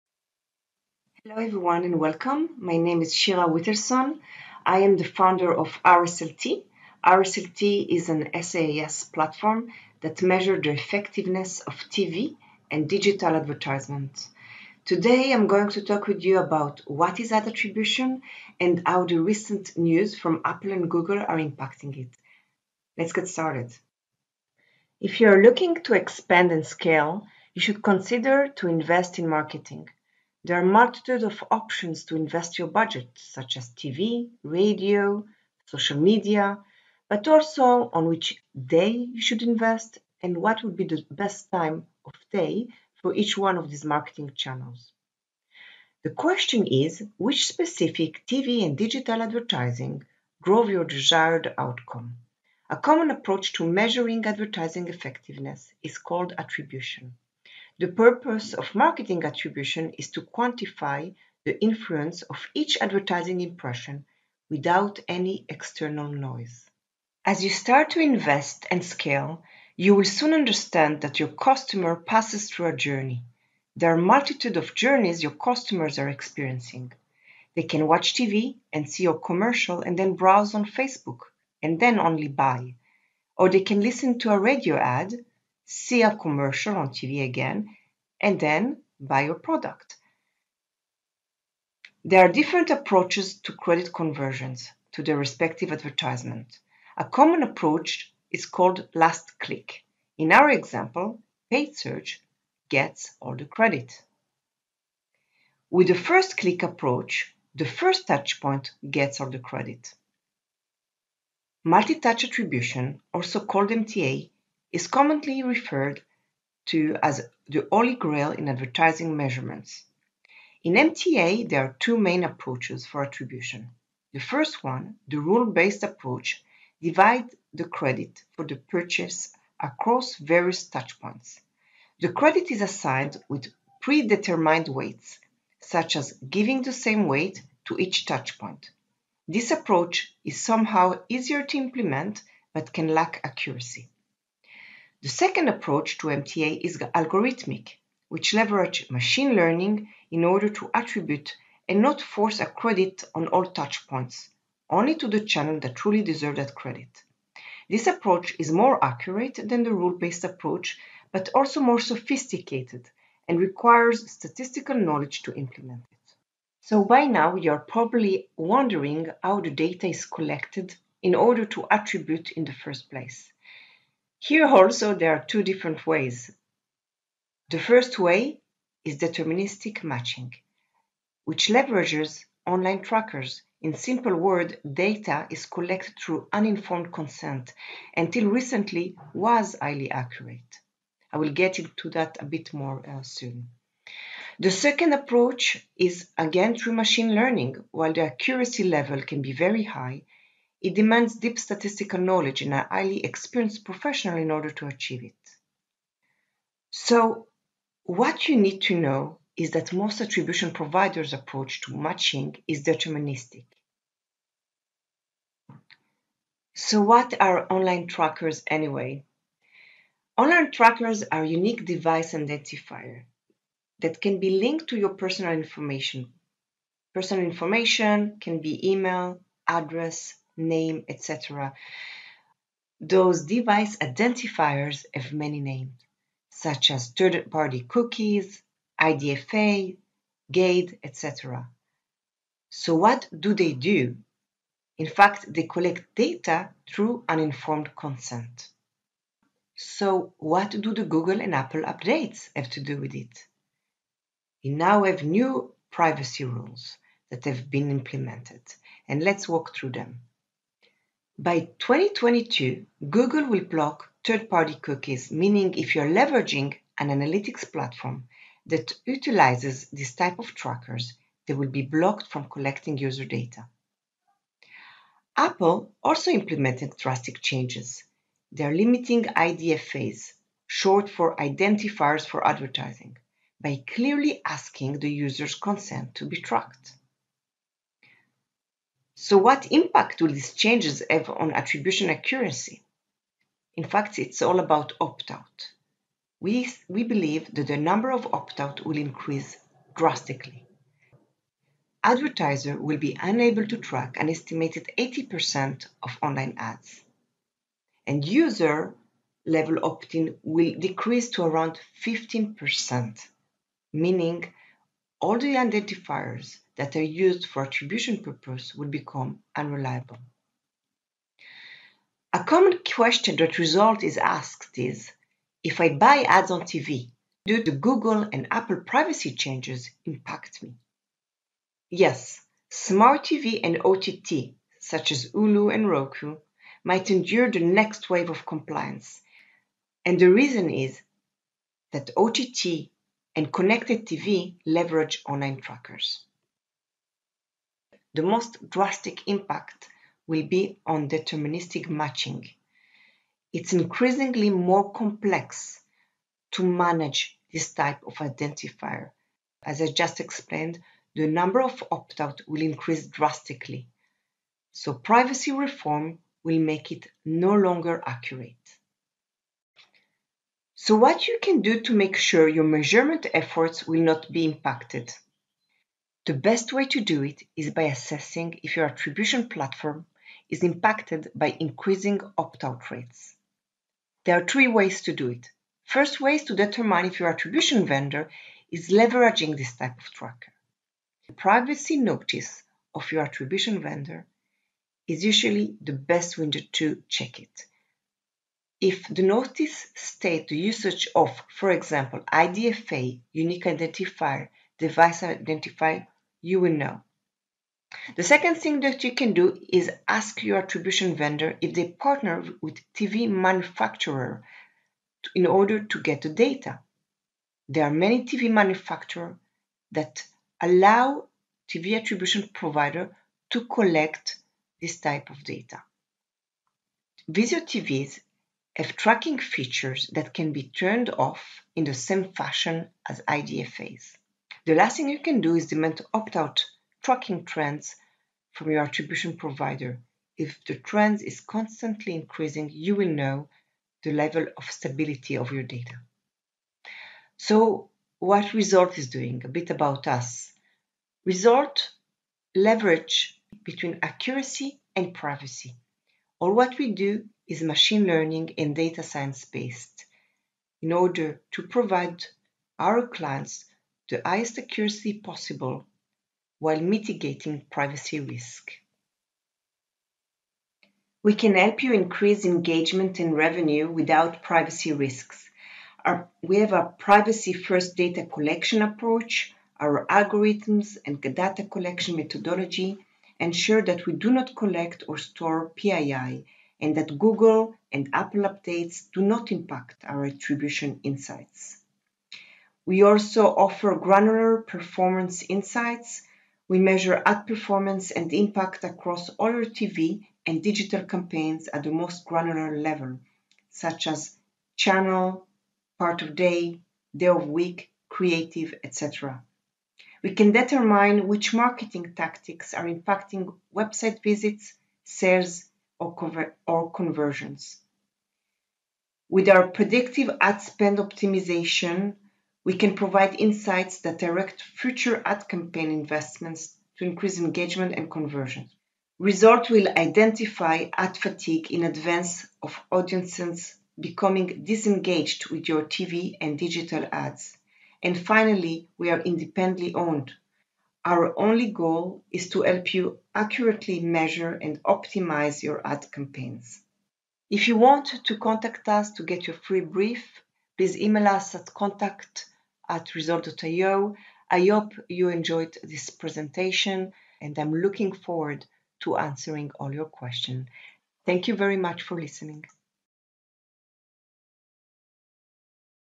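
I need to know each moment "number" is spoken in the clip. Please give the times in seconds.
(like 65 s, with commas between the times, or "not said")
297 s, 361 s.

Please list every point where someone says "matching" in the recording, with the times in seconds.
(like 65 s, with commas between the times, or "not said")
179 s, 211 s, 351 s.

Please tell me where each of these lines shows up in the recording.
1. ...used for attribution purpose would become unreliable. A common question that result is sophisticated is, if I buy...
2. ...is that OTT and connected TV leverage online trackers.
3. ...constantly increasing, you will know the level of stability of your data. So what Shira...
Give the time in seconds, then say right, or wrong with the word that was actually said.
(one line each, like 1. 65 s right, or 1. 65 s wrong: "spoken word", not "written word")
1. 316 s wrong: "asked", not "sophisticated"
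2. 340 s right
3. 441 s wrong: "RSLT", not "Shira".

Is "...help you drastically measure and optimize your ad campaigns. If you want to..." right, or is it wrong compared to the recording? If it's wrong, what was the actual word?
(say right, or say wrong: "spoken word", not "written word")
wrong: "accurately", not "drastically".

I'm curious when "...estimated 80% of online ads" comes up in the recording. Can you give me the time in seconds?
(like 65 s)
304 s.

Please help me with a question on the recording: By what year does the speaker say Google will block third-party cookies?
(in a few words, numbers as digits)
2022.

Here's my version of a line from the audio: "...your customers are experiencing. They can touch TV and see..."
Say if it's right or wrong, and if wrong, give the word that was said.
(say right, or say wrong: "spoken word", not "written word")
wrong: "watch", not "touch".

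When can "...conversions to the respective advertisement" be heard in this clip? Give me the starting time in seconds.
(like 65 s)
93 s.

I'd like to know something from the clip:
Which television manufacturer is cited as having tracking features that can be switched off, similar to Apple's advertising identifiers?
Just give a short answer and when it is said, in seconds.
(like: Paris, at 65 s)
Vizio, at 427 s.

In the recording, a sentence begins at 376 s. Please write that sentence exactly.
The best way to do it is by assessing if your attribution platform is impacted by increasing opt-out rates.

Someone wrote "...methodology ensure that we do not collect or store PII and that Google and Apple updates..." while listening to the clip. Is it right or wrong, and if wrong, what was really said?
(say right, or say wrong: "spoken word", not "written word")
right.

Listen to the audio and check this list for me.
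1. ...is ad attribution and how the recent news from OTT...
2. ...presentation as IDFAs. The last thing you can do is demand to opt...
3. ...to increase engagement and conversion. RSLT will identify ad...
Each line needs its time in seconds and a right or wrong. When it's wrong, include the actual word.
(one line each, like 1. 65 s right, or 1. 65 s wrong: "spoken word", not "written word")
1. 17 s wrong: "Apple", not "OTT"
2. 432 s wrong: "fashion", not "presentation"
3. 526 s right.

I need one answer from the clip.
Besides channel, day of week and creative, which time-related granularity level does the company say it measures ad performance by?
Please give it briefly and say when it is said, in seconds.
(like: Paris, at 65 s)
Part of day, at 505 s.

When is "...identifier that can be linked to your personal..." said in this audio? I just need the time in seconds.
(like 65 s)
222 s.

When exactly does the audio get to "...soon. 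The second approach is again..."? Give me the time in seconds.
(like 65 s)
193 s.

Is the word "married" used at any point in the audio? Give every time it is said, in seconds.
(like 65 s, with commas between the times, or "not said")
not said.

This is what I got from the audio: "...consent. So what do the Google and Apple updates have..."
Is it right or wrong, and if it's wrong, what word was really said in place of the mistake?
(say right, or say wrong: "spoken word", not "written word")
right.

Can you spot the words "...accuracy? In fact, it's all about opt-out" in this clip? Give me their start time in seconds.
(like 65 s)
291 s.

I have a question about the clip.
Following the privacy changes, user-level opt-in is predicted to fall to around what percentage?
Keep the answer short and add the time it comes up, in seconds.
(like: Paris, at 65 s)
15%, at 311 s.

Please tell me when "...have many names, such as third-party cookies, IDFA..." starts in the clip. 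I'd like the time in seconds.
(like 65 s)
234 s.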